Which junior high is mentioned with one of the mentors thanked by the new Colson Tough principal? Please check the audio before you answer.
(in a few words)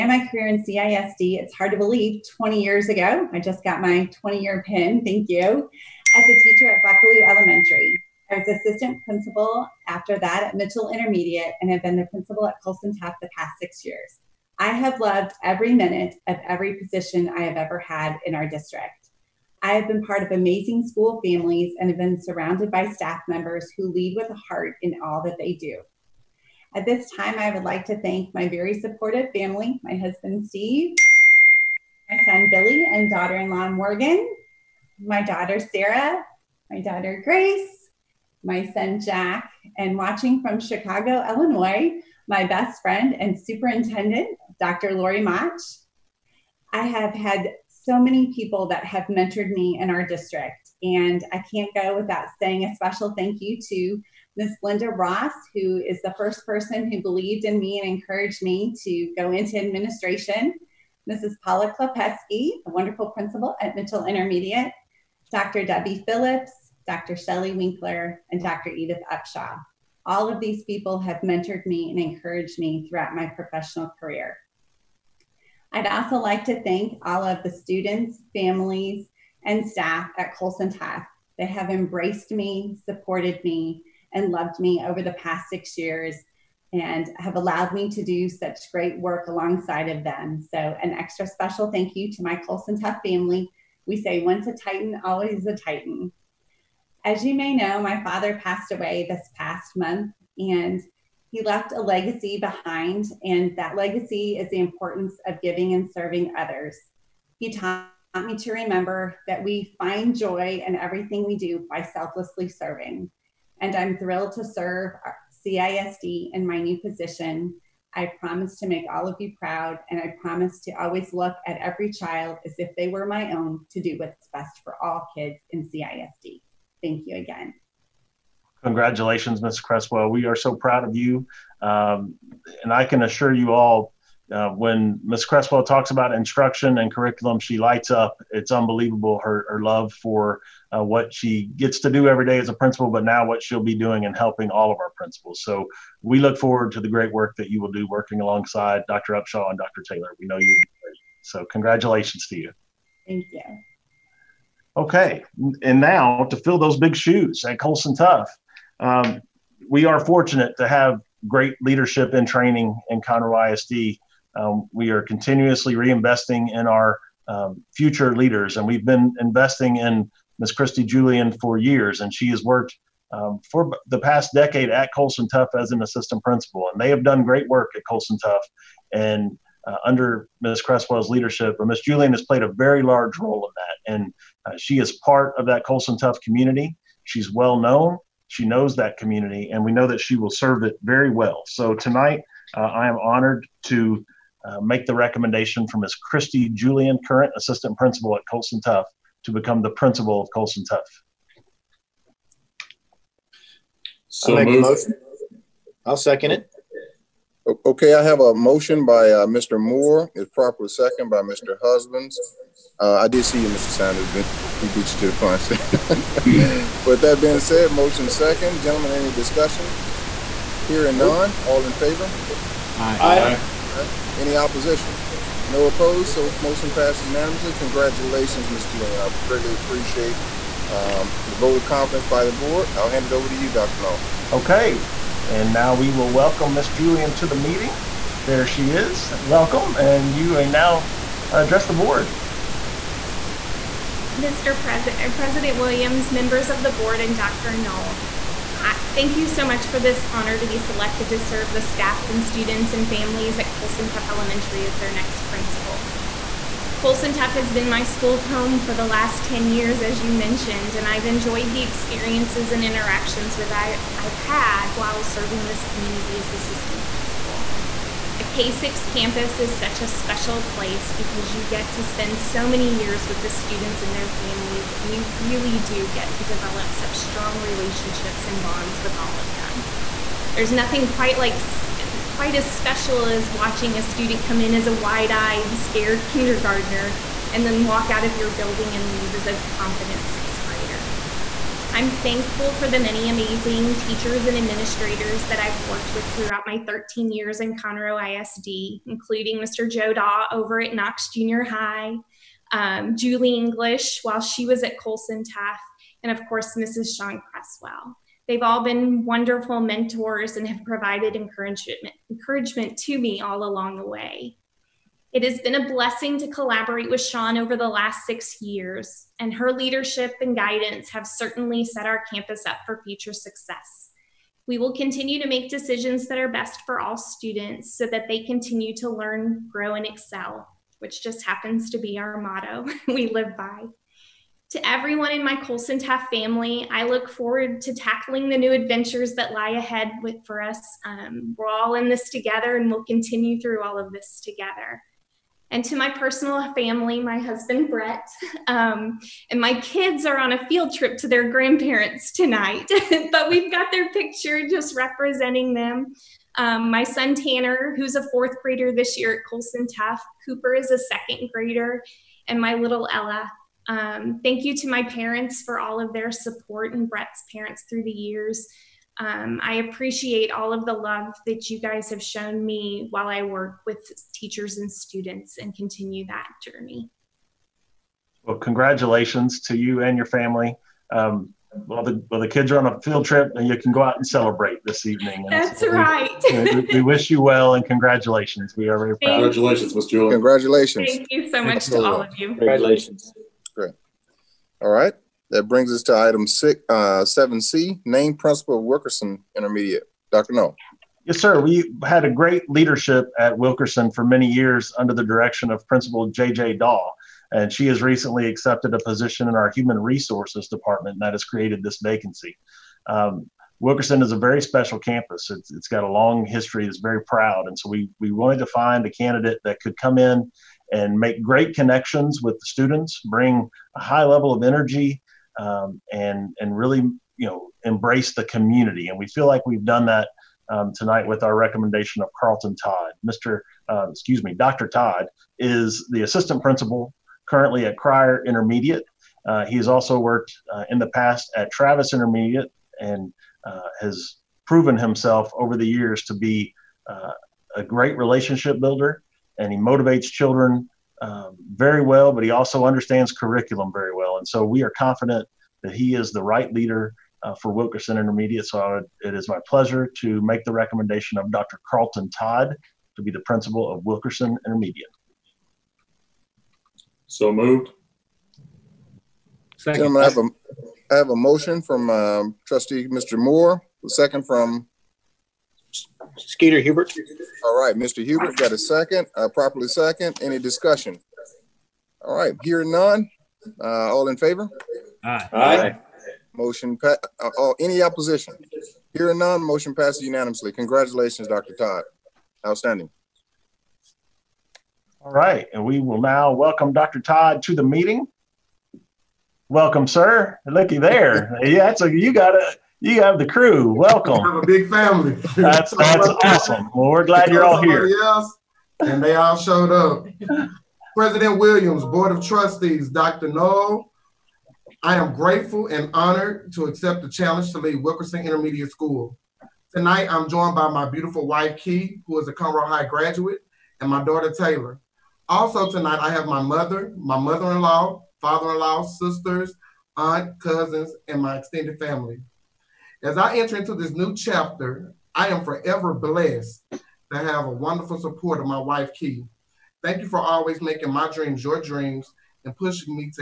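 Knox Junior High.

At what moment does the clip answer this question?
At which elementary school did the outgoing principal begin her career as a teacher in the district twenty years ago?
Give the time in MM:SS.
00:06.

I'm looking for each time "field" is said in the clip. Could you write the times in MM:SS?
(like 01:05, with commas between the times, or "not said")
05:50, 06:22.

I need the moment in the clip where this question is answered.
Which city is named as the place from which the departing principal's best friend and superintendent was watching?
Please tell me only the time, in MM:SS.
00:40.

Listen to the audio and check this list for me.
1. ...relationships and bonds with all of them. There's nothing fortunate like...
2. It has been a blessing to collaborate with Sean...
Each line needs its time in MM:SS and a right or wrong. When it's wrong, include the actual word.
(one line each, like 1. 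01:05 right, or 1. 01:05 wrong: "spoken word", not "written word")
1. 04:37 wrong: "quite", not "fortunate"
2. 05:15 right.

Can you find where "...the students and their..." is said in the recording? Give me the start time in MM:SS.
04:33.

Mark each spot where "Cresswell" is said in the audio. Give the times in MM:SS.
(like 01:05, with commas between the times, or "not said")
02:09, 02:15, 03:00, 05:07.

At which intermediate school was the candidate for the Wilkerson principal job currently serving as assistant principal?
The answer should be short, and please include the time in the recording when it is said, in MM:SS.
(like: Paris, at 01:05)
Cryar Intermediate, at 07:17.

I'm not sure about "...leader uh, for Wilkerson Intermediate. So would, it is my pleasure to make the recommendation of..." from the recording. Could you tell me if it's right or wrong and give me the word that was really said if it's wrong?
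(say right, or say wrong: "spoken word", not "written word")
right.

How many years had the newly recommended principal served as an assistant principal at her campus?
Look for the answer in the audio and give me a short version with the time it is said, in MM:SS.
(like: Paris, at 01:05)
10, at 02:53.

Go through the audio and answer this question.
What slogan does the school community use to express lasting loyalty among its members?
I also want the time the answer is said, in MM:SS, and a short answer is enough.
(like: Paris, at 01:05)
Once a Titan, always a Titan, at 01:34.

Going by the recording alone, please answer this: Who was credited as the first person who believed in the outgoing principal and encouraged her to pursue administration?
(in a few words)
Linda Ross.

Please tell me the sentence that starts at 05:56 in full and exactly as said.
Um, my son Tanner, who's a fourth grader this year at Colson Tough, Cooper is a second grader, and my little Ella.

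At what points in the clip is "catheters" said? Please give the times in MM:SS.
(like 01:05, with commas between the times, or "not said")
not said.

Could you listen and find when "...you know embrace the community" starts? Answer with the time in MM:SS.
07:07.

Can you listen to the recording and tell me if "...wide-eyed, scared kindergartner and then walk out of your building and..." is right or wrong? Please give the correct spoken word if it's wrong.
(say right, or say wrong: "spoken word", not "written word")
right.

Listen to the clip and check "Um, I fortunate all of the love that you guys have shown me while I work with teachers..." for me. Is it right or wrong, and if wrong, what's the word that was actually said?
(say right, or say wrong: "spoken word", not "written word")
wrong: "appreciate", not "fortunate".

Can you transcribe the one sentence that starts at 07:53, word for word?
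Moore, the second from Skeeter Hubert.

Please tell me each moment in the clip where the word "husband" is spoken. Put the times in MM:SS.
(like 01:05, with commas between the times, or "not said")
00:29, 03:31, 05:47.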